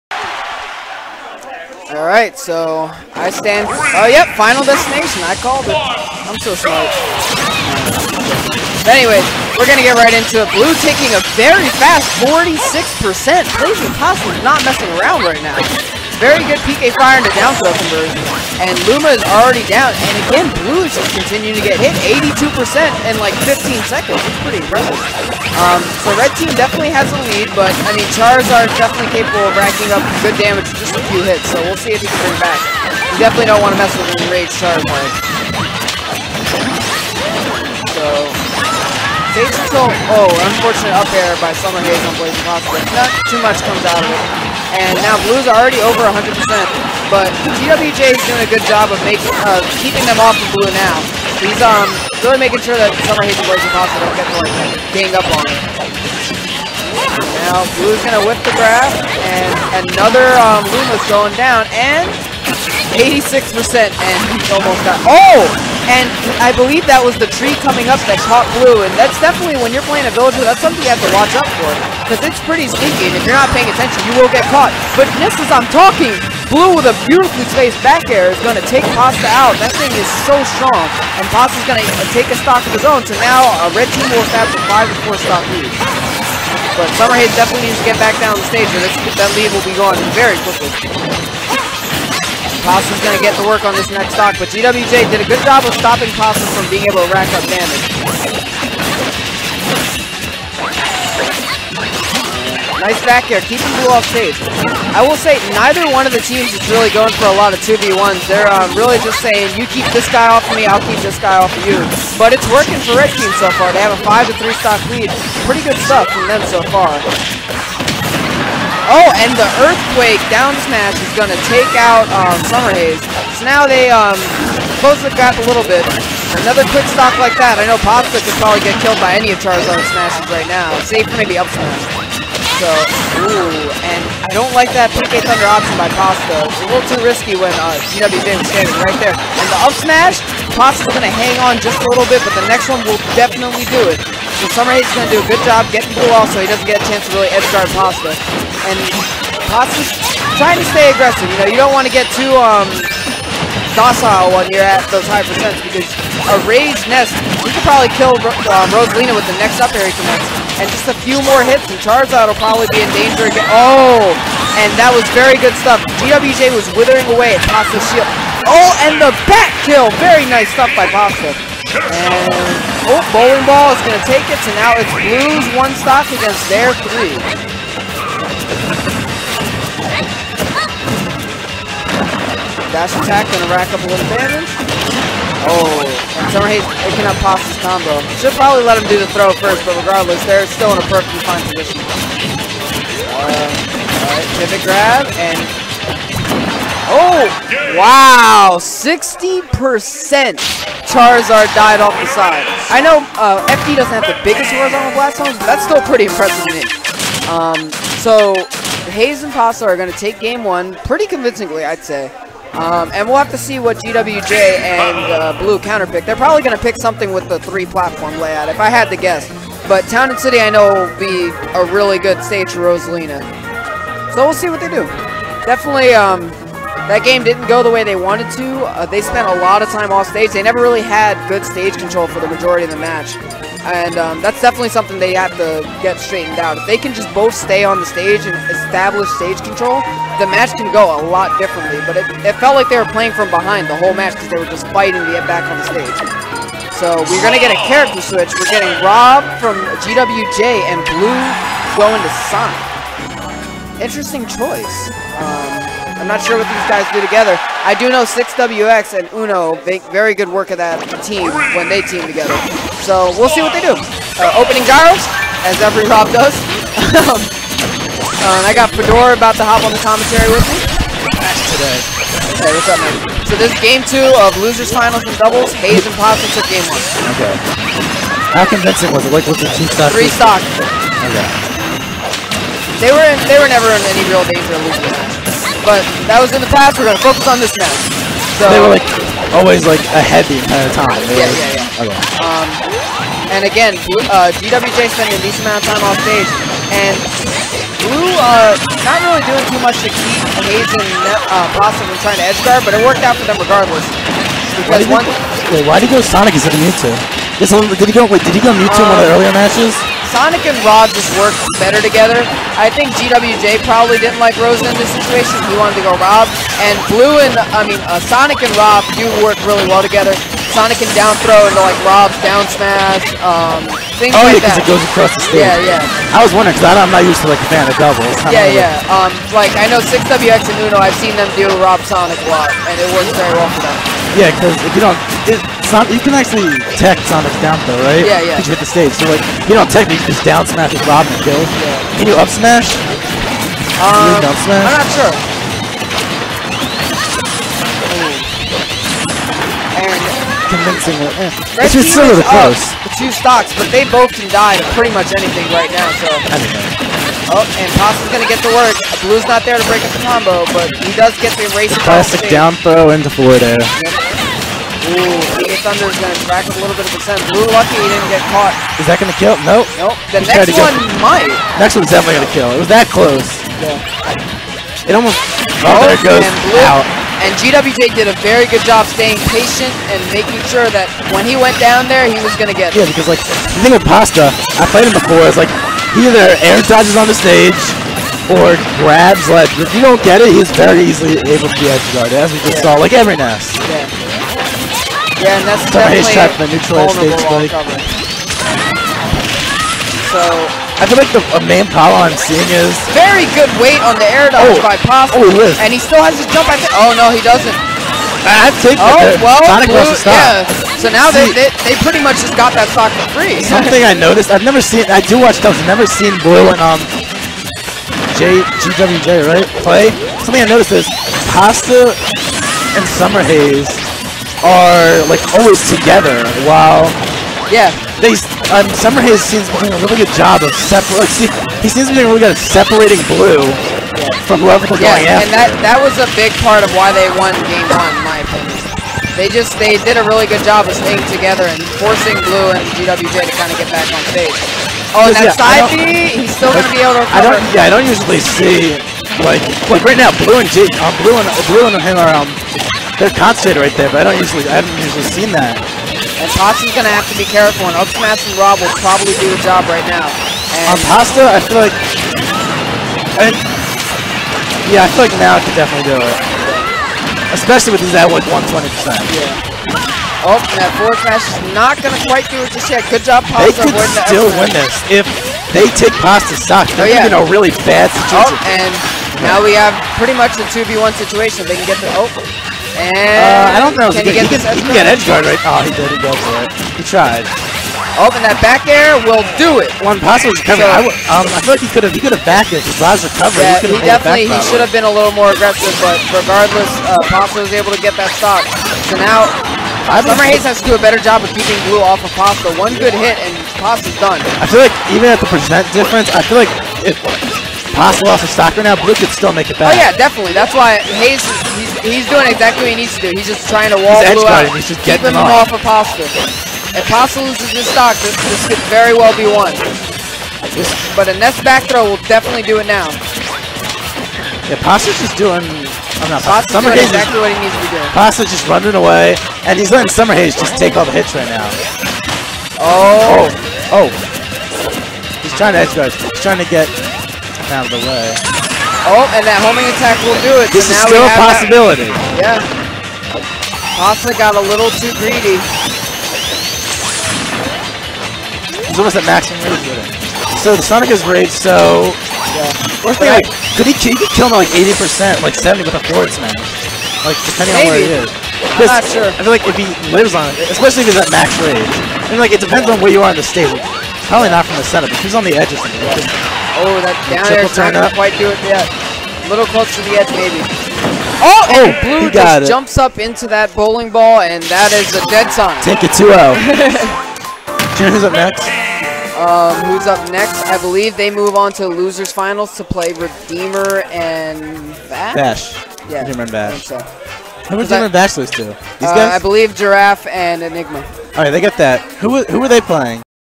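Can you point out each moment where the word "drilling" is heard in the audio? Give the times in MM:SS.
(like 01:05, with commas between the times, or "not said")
not said.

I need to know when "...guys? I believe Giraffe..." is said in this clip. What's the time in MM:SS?
09:48.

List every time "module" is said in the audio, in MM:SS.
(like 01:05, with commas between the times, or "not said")
not said.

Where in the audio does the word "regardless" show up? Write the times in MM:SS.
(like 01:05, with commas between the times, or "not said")
03:09, 05:03, 08:16.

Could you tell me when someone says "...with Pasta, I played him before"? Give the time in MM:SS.
06:23.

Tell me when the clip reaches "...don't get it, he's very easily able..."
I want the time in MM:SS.
06:29.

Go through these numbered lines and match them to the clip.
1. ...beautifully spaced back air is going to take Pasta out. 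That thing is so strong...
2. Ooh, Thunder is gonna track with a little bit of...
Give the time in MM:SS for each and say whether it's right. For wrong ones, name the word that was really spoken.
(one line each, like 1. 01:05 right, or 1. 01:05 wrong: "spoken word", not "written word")
1. 01:17 right
2. 06:04 right.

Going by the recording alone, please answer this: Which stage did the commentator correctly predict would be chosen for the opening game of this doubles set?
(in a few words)
Final Destination.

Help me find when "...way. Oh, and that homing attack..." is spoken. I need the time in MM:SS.
08:57.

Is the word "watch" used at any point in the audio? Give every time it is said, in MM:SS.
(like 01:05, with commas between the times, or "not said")
01:11, 06:55.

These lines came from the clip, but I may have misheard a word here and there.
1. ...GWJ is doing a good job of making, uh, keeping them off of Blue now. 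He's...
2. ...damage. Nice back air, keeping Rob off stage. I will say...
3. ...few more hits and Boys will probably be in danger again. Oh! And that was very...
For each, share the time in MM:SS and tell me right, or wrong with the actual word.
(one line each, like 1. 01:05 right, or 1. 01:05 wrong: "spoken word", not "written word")
1. 00:47 right
2. 01:37 wrong: "Blue", not "Rob"
3. 02:40 wrong: "Charizard", not "Boys".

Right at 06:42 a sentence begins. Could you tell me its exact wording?
Very good weight on the air dodge oh.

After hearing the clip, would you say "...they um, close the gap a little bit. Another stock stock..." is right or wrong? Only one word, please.
wrong.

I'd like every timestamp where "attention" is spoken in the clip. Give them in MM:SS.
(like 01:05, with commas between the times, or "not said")
01:13.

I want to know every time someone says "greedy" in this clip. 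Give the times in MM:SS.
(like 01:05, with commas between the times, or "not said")
09:04.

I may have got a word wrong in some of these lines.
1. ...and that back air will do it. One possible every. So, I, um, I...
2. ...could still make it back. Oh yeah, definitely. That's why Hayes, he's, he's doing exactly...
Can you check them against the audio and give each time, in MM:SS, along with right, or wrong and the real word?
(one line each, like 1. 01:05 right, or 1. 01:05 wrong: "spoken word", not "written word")
1. 08:08 wrong: "recovery", not "every"
2. 08:28 right.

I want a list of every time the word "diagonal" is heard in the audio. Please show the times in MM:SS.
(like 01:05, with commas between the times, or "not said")
not said.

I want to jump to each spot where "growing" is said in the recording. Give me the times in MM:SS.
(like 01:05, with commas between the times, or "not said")
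not said.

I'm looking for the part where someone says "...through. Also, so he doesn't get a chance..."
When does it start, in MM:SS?
02:25.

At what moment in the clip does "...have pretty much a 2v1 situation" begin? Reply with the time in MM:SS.
07:59.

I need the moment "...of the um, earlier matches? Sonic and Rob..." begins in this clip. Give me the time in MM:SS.
05:08.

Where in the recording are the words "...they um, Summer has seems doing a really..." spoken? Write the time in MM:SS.
07:08.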